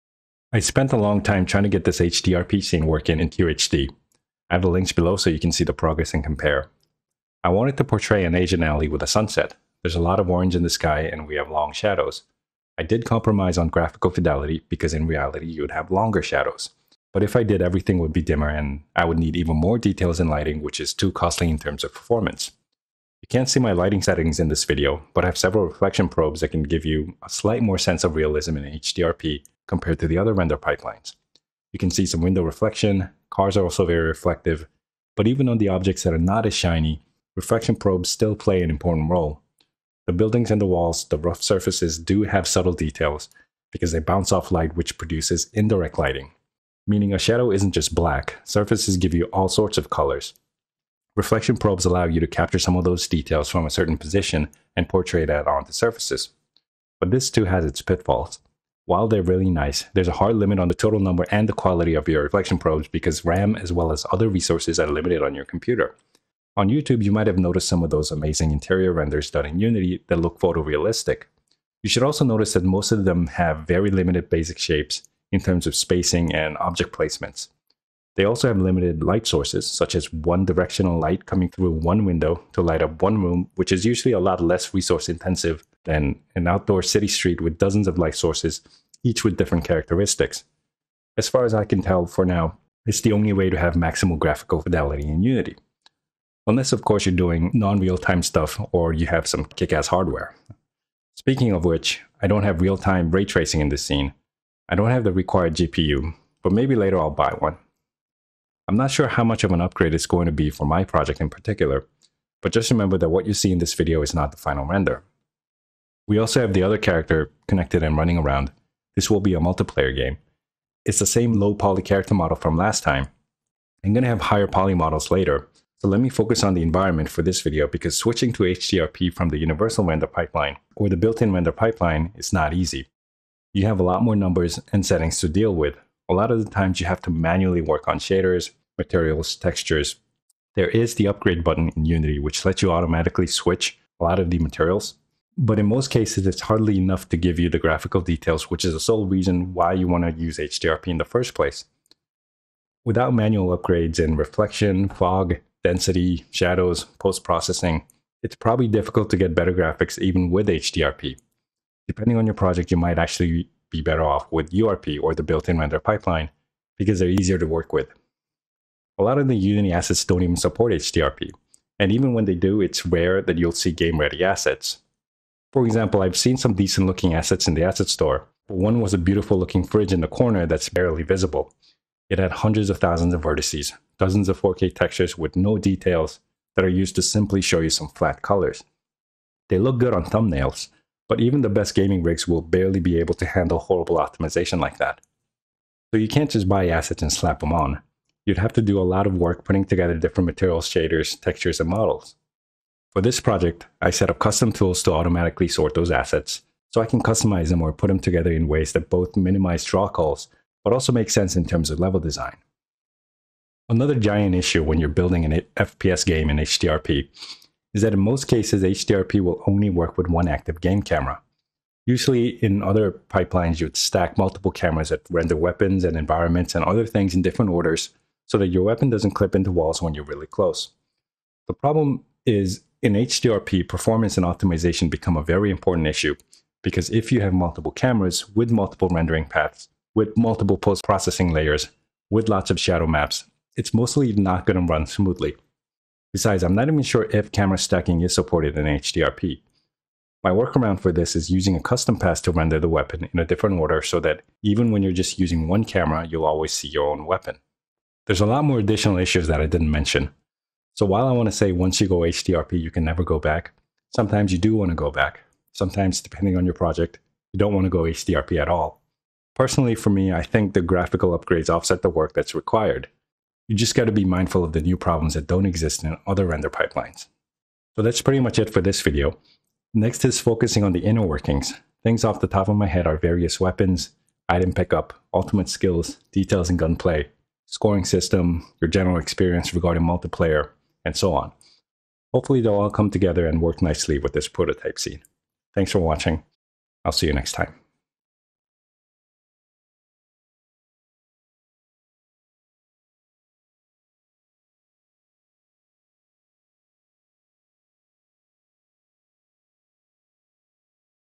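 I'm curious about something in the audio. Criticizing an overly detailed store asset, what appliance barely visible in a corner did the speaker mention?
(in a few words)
fridge.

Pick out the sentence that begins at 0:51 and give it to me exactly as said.
Reflection probes allow you to capture some of those details from a certain position and portray that onto surfaces.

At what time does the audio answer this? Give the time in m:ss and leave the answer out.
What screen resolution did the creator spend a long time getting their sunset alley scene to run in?
0:03.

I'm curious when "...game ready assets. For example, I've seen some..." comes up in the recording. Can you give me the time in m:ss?
2:53.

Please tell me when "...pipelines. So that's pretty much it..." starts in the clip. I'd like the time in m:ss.
4:36.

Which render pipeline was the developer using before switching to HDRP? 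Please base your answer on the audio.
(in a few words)
universal render pipeline.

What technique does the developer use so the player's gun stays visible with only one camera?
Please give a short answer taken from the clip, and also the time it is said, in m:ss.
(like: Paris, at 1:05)
custom pass, at 4:11.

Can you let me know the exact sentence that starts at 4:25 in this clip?
Sometimes, depending on your project, you don't want to go HDRP at all.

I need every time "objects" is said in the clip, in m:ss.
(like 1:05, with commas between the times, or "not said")
0:35, 1:16.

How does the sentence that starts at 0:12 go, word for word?
I did compromise on graphical fidelity because in reality you would have longer shadows.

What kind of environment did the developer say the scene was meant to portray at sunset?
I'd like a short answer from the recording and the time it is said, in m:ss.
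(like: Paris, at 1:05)
Asian alley, at 0:08.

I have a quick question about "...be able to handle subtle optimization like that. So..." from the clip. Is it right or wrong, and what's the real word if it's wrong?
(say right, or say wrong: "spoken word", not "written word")
wrong: "horrible", not "subtle".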